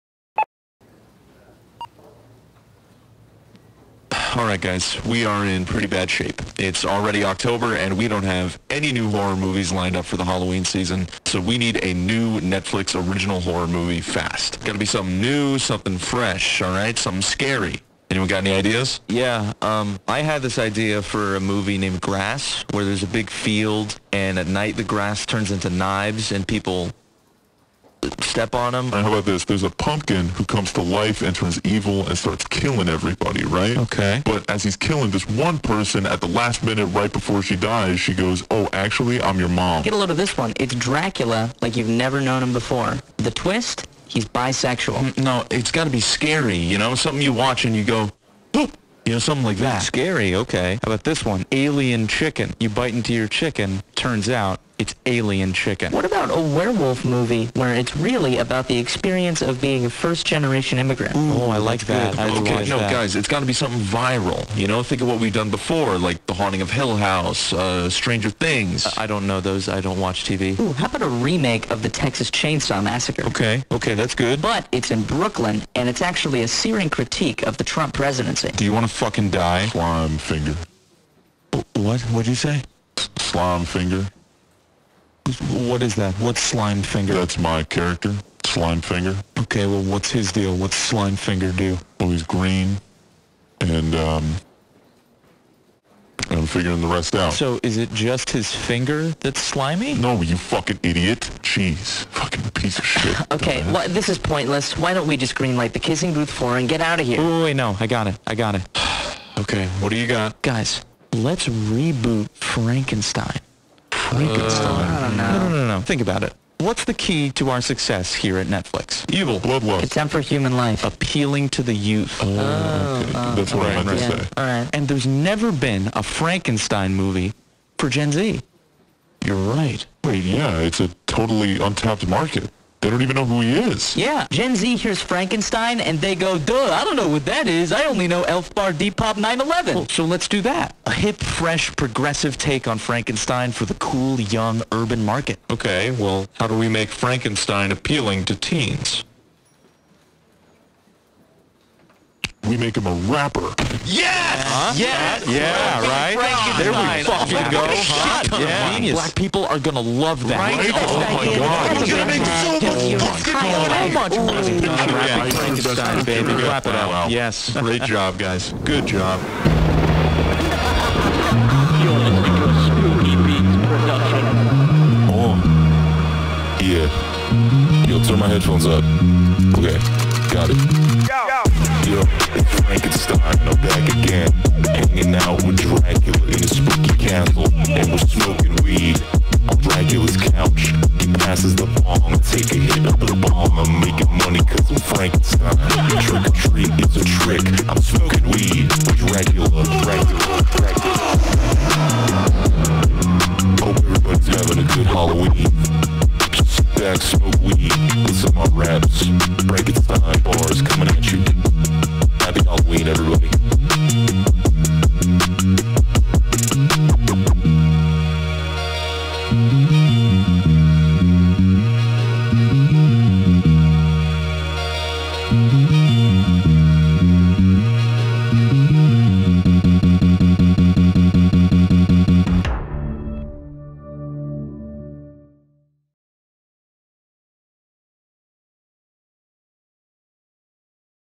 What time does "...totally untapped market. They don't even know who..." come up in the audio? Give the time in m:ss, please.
2:11.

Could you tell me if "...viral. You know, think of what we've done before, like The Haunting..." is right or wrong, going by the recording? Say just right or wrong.
right.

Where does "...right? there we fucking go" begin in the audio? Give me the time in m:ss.
2:35.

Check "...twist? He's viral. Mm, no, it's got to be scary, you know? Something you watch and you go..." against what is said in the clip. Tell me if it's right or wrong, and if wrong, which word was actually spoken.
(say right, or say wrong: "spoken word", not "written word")
wrong: "bisexual", not "viral".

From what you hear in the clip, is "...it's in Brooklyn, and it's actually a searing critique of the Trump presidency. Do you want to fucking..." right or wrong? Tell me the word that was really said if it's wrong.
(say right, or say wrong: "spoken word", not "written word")
right.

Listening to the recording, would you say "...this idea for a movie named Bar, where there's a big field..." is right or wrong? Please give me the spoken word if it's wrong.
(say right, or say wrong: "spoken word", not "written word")
wrong: "Grass", not "Bar".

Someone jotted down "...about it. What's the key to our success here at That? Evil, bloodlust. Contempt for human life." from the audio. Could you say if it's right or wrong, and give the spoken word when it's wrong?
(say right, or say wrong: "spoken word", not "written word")
wrong: "Netflix", not "That".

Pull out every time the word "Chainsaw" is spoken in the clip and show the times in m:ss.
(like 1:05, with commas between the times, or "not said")
1:12.